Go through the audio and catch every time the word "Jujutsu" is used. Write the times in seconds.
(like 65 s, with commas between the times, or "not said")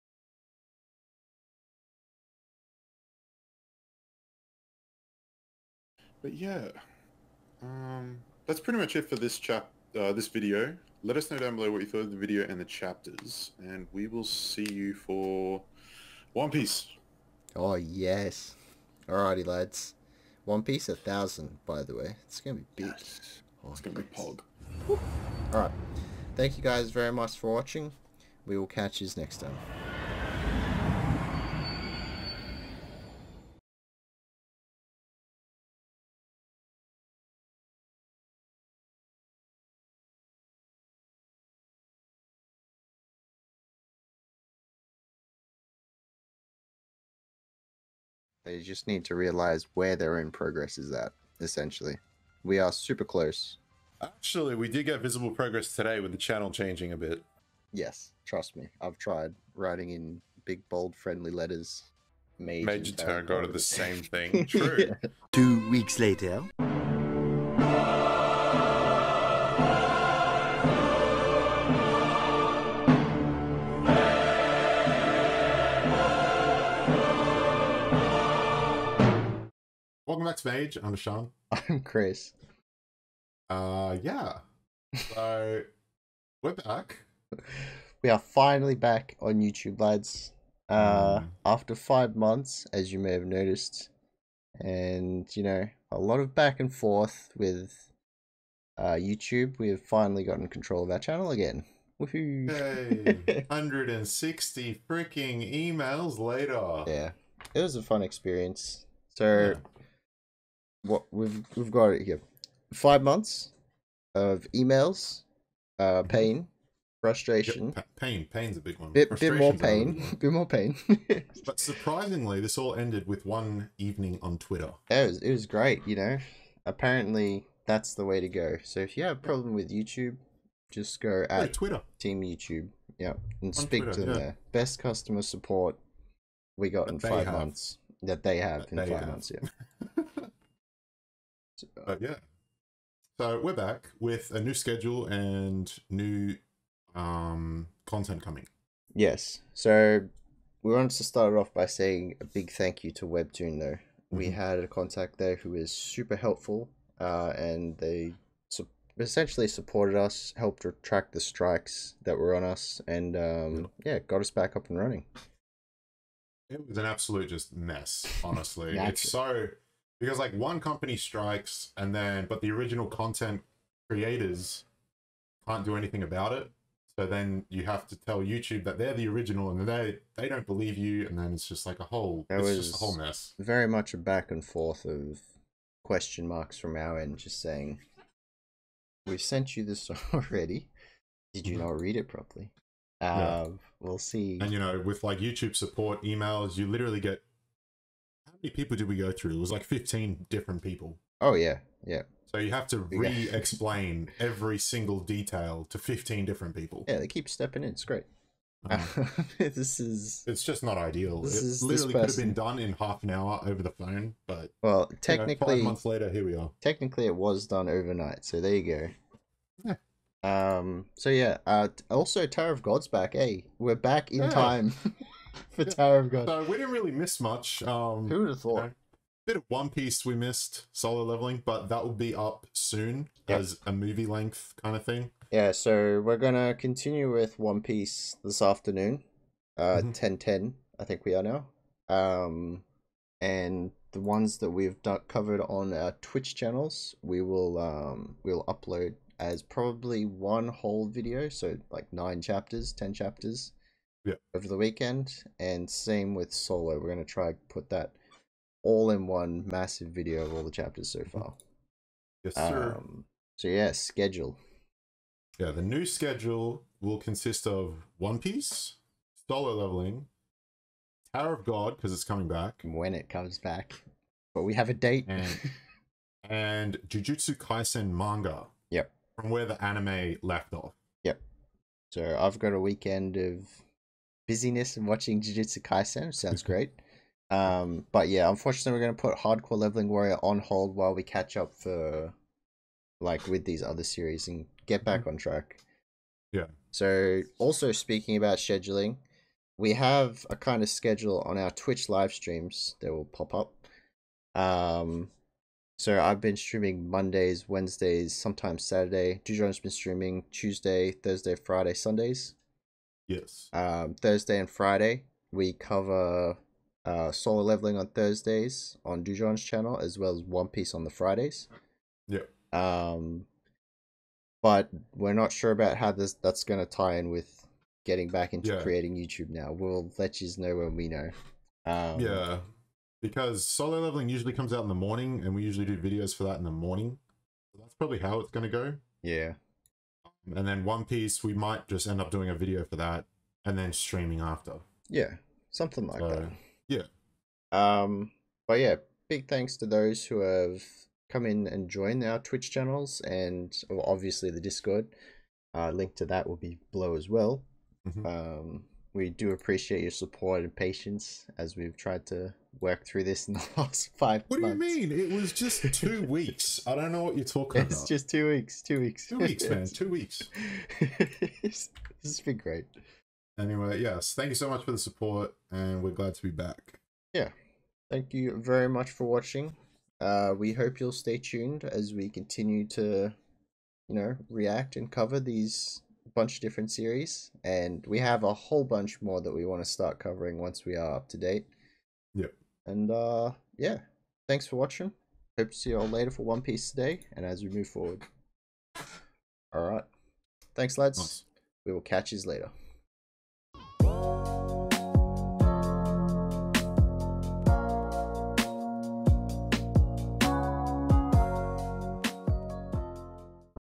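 276 s, 285 s.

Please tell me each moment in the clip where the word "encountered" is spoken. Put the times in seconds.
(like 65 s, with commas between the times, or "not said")
not said.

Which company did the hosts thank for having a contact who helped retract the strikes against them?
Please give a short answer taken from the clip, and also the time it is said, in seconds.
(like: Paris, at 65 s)
Webtoon, at 153 s.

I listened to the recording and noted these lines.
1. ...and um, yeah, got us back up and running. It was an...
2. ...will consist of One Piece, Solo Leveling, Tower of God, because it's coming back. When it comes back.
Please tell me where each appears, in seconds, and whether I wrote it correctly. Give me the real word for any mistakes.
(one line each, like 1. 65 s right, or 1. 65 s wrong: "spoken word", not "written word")
1. 162 s right
2. 266 s right.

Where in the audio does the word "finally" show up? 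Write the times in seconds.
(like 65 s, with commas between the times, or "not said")
88 s, 99 s.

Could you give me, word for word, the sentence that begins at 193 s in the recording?
Uh, we'll see and you know with like youtube support emails you literally get many people did we go through?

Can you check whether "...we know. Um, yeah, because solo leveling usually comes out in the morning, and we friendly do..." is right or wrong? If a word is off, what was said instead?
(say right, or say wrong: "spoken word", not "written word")
wrong: "usually", not "friendly".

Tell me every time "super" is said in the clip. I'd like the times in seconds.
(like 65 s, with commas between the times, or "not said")
52 s, 155 s.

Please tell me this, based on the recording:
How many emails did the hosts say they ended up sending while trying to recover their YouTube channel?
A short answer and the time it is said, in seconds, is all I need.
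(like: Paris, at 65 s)
160, at 103 s.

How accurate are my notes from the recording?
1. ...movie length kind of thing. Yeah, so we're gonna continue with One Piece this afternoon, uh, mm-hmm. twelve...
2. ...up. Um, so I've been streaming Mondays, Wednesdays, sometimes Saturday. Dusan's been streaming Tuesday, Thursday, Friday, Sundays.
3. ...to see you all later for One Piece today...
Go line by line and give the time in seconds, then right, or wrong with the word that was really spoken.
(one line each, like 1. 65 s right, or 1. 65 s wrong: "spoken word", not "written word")
1. 233 s wrong: "ten", not "twelve"
2. 303 s right
3. 395 s right.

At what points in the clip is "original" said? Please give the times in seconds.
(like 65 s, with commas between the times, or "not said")
172 s, 179 s.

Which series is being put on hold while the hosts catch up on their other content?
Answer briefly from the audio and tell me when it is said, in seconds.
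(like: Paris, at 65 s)
Hardcore Leveling Warrior, at 289 s.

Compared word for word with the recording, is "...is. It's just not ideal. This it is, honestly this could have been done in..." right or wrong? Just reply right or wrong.
wrong.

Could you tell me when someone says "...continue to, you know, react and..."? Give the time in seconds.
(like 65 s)
382 s.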